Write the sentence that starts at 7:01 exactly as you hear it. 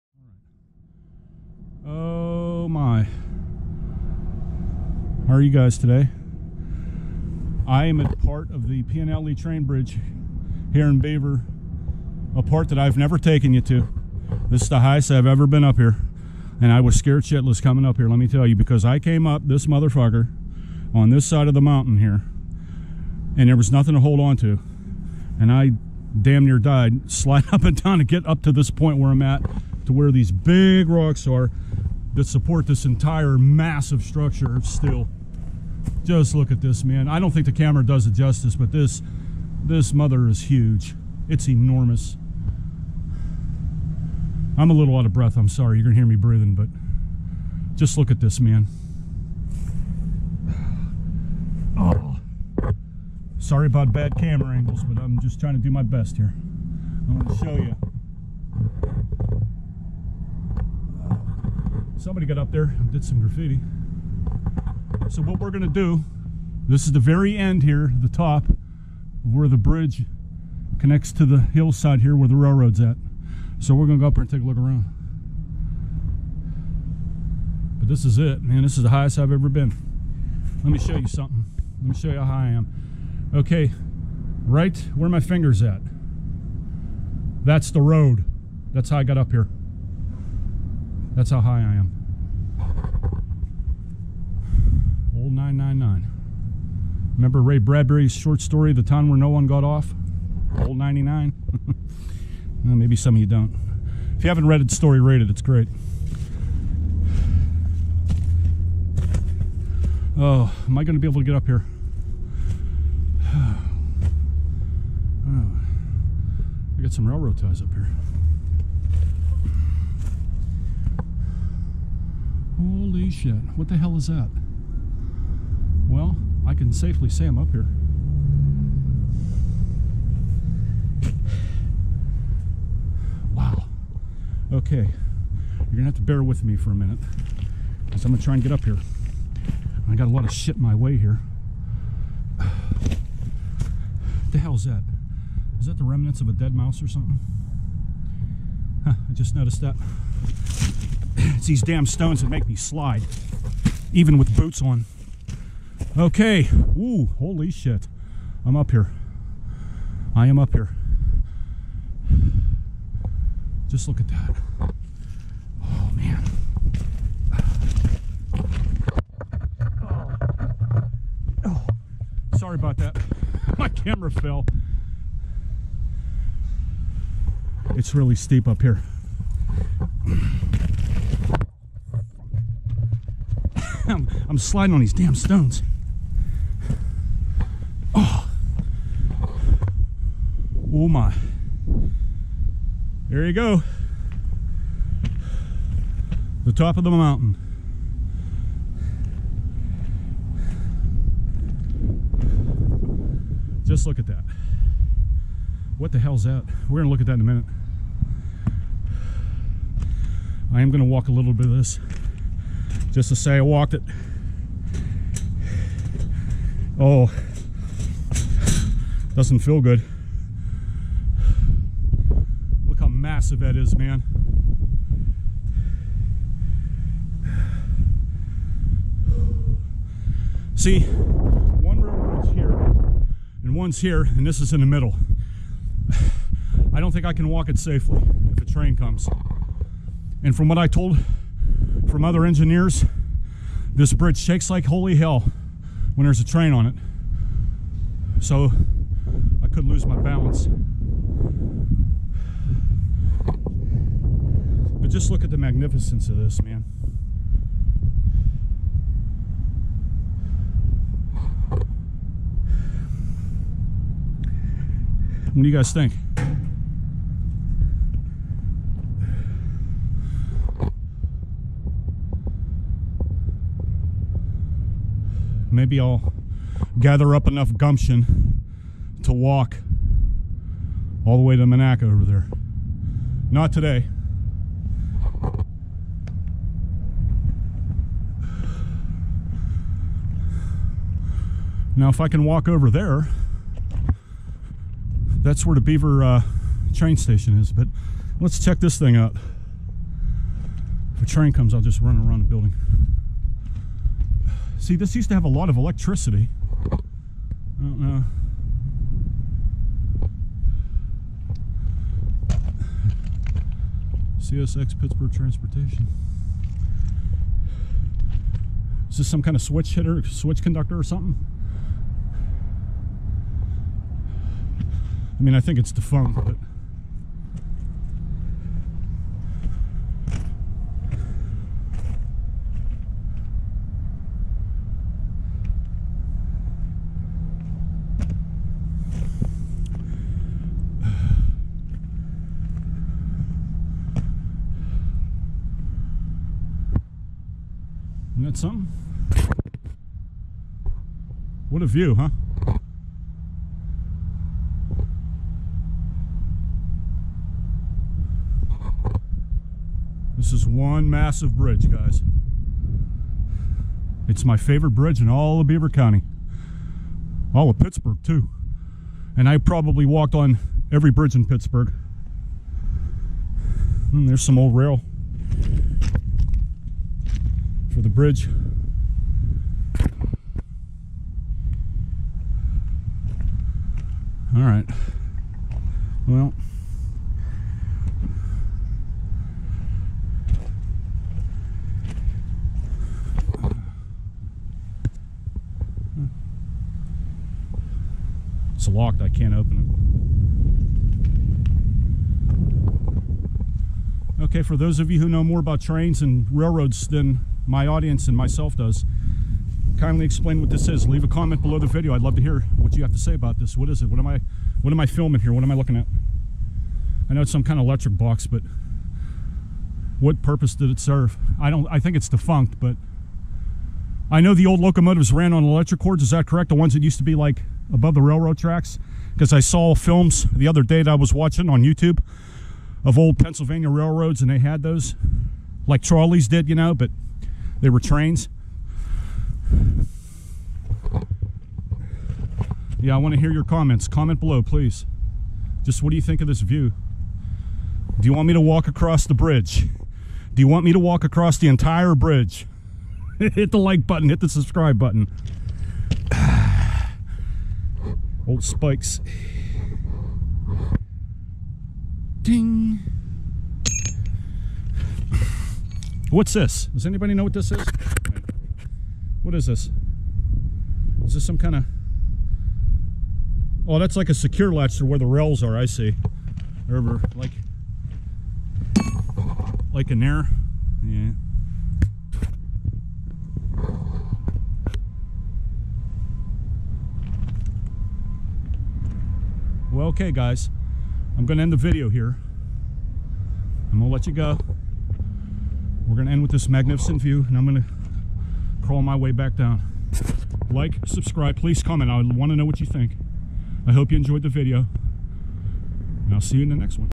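I don't I think it's defunct, but I know the old locomotives ran on electric cords, is that correct?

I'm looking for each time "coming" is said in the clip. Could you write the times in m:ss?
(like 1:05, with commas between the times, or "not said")
0:17.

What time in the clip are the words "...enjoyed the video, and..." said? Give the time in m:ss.
8:23.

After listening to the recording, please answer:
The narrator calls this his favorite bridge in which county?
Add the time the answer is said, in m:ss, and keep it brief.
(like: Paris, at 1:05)
Beaver County, at 6:05.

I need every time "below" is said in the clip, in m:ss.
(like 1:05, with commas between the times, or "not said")
6:51, 7:24.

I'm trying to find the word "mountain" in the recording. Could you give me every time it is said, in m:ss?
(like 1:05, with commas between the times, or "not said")
0:21, 3:16.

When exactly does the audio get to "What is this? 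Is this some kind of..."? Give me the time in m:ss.
7:49.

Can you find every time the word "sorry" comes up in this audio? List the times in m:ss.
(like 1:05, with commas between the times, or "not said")
0:45, 0:53, 2:52.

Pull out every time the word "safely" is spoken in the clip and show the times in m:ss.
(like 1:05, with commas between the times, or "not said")
2:06, 3:57.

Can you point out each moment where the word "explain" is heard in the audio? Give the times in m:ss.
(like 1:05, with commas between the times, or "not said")
6:50.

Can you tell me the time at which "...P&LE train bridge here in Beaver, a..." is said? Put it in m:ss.
0:08.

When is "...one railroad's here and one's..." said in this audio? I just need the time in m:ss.
3:50.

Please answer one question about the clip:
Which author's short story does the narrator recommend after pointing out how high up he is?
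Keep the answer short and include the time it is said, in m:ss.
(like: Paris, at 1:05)
Ray Bradbury, at 1:37.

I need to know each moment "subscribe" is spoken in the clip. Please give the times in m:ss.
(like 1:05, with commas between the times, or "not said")
7:34, 8:20.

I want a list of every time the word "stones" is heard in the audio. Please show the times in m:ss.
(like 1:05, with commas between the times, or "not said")
2:31, 3:05.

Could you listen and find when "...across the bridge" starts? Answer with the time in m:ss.
7:28.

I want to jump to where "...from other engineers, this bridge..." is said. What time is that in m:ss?
4:01.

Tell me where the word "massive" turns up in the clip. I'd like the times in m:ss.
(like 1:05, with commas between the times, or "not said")
0:33, 3:43, 6:00.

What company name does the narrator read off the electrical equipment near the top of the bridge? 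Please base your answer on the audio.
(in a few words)
CSX Pittsburgh Transportation.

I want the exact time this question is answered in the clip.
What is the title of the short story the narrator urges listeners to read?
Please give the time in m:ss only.
1:38.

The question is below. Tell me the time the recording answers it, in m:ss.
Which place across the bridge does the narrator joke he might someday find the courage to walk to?
4:41.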